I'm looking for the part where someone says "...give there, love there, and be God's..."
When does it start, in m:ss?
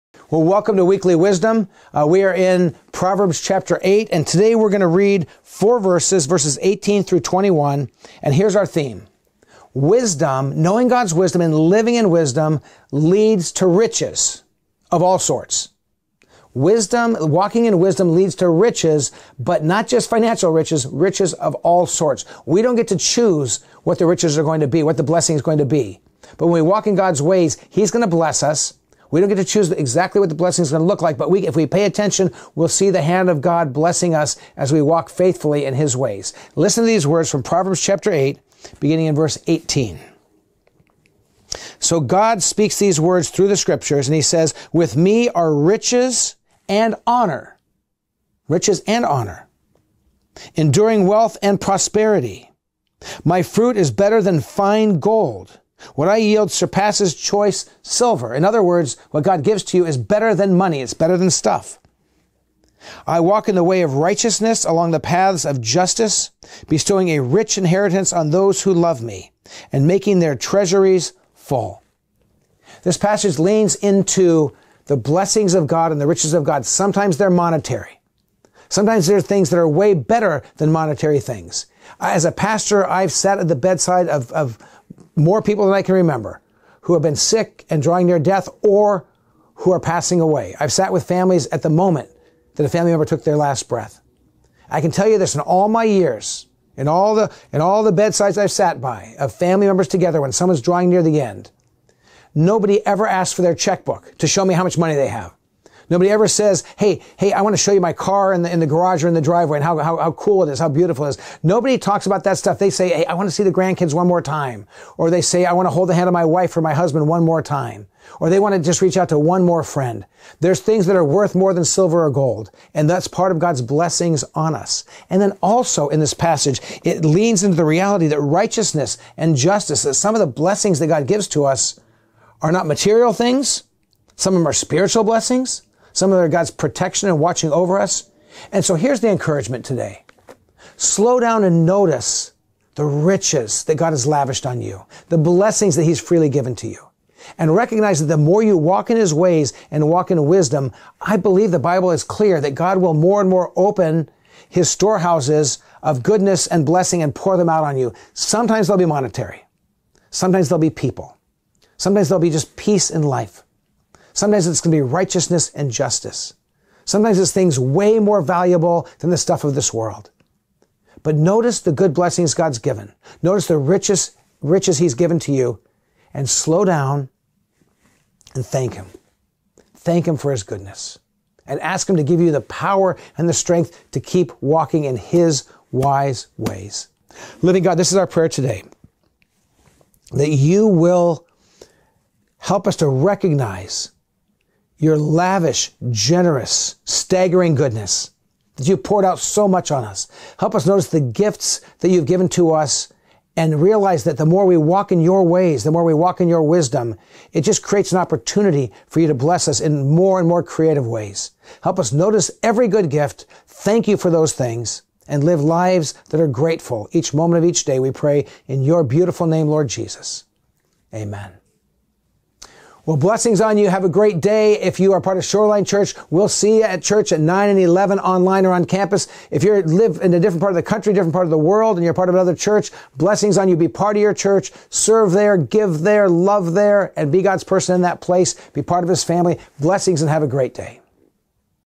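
3:55.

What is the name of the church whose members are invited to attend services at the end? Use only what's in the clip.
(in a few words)
Shoreline Church.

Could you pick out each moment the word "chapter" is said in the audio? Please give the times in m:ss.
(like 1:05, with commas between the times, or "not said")
0:03, 0:37.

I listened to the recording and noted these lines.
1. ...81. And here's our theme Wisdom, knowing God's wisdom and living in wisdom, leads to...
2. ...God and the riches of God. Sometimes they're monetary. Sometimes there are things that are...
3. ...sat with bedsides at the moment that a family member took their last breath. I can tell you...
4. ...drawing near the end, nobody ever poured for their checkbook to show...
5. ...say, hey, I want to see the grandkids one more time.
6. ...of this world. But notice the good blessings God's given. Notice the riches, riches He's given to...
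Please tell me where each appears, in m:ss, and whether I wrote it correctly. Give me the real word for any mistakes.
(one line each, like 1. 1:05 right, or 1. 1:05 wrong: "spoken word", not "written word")
1. 0:07 wrong: "21", not "81"
2. 1:15 right
3. 1:30 wrong: "families", not "bedsides"
4. 1:40 wrong: "asked", not "poured"
5. 1:52 right
6. 2:49 right.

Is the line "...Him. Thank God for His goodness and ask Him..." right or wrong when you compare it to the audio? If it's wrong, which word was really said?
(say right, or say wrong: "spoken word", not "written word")
wrong: "Him", not "God".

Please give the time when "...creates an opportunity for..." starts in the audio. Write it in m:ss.
3:27.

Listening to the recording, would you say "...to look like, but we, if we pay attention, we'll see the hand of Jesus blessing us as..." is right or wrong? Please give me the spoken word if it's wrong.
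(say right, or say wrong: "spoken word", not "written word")
wrong: "God", not "Jesus".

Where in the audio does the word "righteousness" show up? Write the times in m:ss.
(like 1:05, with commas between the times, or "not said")
1:03, 2:08, 2:44.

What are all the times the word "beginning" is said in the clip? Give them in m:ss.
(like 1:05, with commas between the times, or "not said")
0:38.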